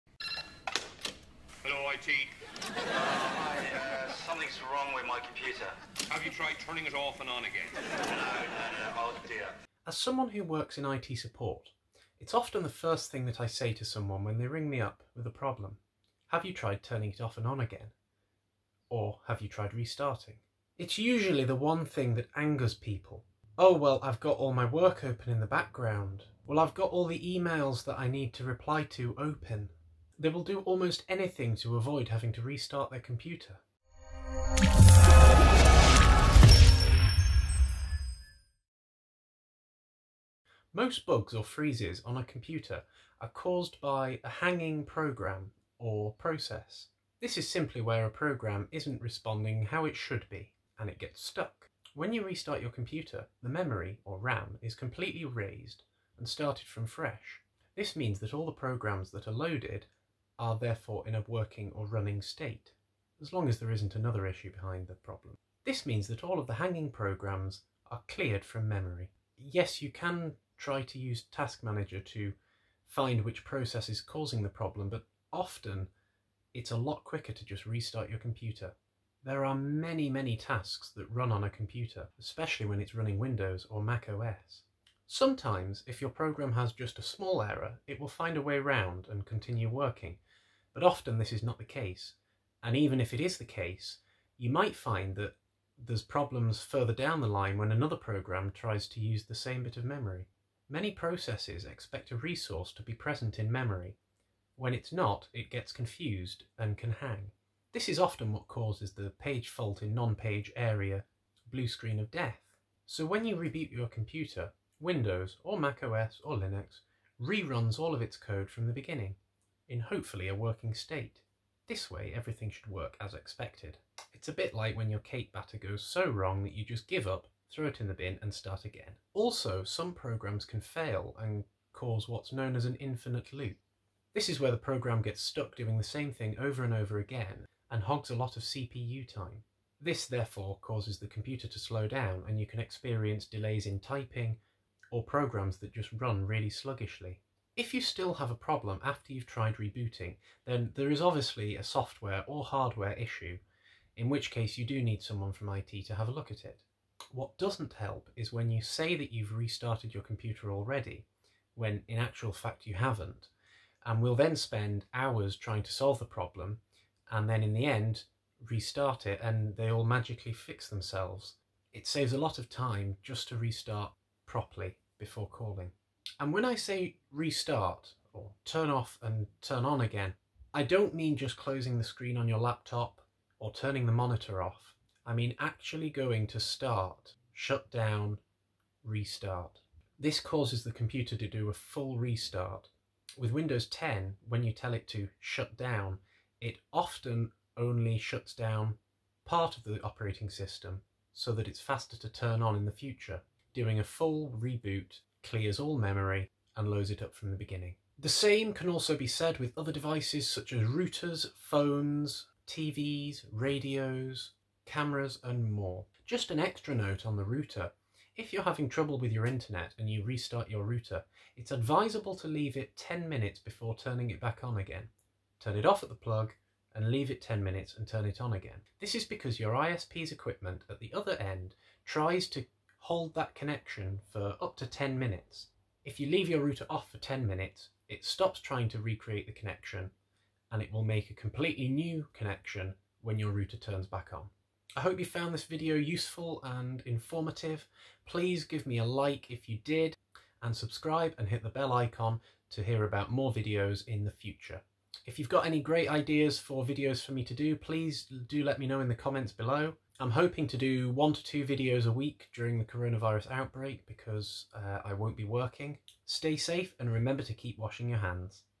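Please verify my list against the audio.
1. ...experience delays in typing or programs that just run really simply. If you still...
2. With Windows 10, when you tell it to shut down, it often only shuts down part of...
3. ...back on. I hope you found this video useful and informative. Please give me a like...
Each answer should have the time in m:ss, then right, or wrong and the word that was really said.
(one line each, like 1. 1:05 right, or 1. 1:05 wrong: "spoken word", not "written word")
1. 2:22 wrong: "sluggishly", not "simply"
2. 3:13 right
3. 4:03 right.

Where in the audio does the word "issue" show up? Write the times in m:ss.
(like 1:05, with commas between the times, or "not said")
1:04, 2:32.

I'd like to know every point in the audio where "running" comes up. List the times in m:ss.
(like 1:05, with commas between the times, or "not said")
1:01, 1:22.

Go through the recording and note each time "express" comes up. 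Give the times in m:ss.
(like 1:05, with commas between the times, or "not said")
not said.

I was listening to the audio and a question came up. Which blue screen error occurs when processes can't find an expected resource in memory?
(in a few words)
Page fault in non-page area.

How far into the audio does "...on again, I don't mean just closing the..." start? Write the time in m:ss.
2:59.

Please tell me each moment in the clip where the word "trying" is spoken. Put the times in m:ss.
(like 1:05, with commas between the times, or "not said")
2:45, 3:58.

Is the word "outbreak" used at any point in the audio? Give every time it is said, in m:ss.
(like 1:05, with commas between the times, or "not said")
4:23.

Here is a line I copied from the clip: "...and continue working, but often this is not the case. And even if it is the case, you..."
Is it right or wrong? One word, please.
right.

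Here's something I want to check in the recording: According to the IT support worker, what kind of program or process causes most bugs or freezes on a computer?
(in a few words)
A hanging program.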